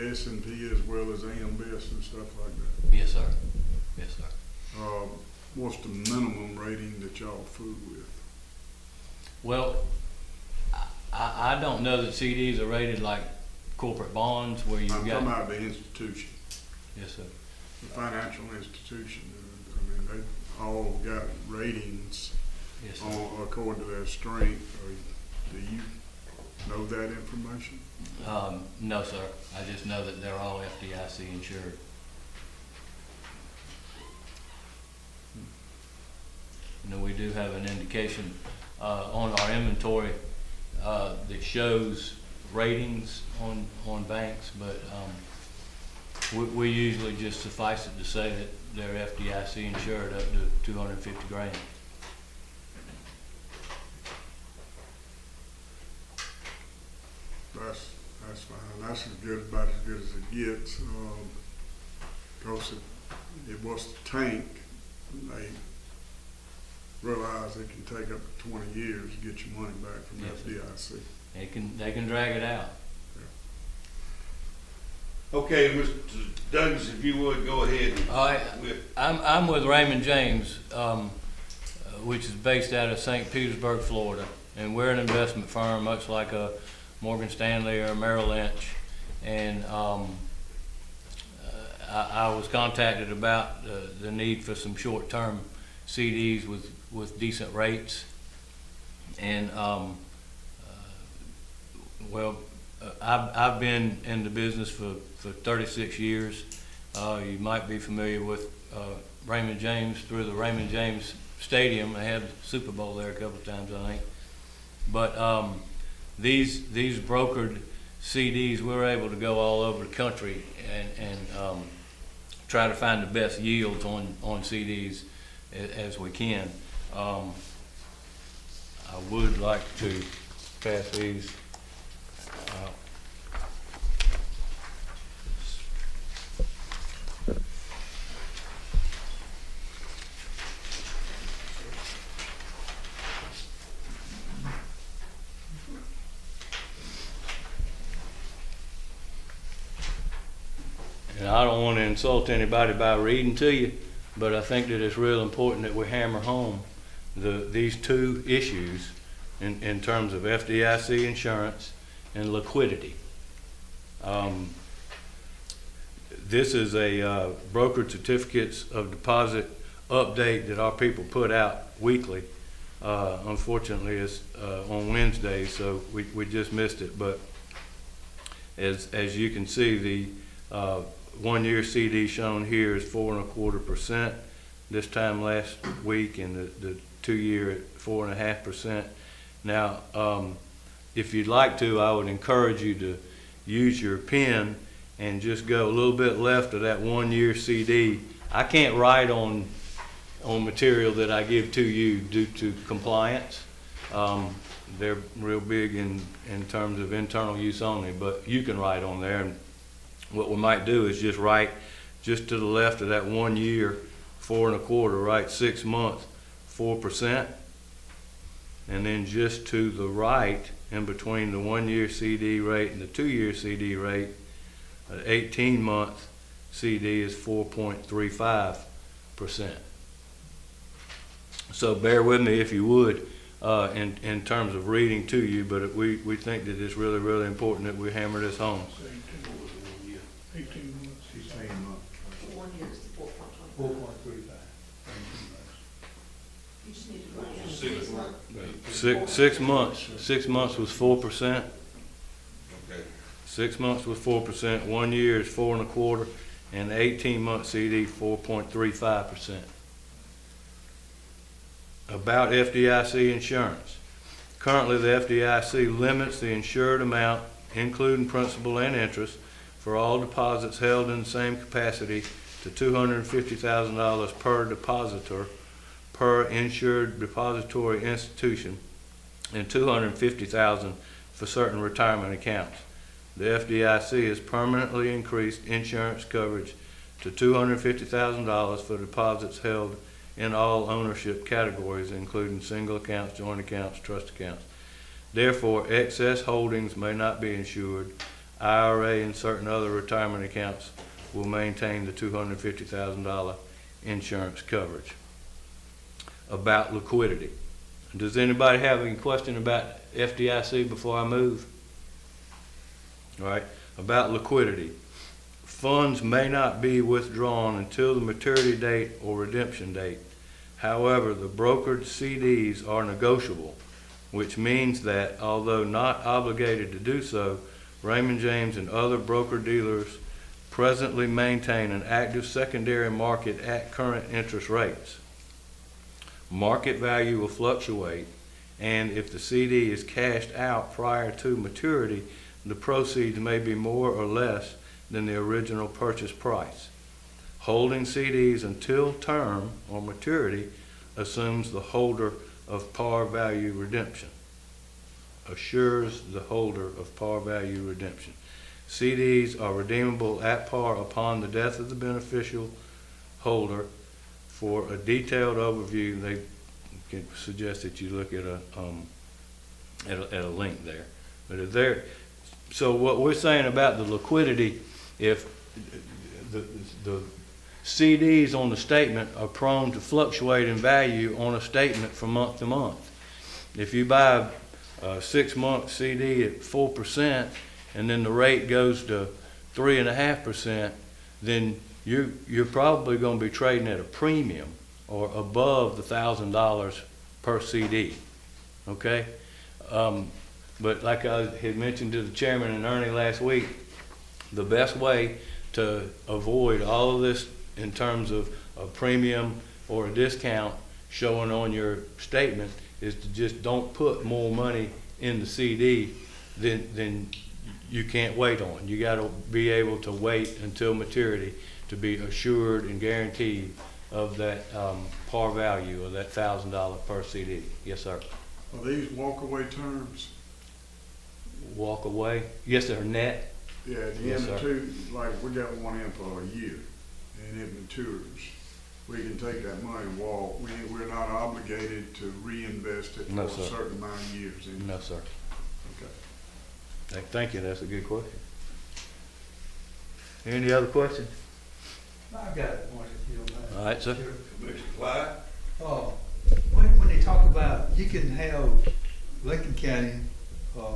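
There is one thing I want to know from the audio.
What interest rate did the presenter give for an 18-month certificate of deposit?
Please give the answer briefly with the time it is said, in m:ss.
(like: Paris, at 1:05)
4.35%, at 3:47.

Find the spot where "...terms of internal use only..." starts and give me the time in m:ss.
3:26.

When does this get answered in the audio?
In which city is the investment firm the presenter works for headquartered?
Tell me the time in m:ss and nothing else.
1:22.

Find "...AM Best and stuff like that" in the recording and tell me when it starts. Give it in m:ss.
0:01.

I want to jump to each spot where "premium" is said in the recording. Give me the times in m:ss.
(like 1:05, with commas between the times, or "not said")
6:33, 6:48.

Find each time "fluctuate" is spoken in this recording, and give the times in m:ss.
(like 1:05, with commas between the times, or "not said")
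5:37, 6:19.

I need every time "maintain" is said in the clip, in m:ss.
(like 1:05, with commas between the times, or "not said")
5:01, 5:31.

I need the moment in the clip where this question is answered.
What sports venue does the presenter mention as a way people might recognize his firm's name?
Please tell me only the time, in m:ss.
1:50.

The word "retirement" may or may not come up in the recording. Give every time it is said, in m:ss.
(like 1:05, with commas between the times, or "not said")
4:41, 4:59.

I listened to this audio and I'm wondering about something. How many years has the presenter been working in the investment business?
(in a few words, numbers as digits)
36 years.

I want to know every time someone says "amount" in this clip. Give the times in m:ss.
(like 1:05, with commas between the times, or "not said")
4:26, 7:23.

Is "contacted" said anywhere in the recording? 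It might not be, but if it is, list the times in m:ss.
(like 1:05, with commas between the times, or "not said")
1:32.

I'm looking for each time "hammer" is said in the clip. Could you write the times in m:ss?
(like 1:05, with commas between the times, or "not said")
2:35, 3:57.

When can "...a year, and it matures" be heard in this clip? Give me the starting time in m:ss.
7:16.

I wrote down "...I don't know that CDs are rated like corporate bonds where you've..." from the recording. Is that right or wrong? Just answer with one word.
right.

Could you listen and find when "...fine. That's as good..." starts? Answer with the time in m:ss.
0:58.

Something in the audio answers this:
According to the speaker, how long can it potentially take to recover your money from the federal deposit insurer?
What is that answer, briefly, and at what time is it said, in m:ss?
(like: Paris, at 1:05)
20 years, at 1:08.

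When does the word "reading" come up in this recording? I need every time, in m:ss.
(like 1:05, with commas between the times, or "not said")
2:32, 3:54.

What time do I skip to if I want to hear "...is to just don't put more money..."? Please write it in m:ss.
6:52.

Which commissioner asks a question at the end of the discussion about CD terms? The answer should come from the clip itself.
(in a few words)
Commissioner Clyde.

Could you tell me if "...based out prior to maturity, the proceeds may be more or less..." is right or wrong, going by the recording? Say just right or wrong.
wrong.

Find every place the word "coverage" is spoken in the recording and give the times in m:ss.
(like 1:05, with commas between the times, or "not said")
4:46, 5:04.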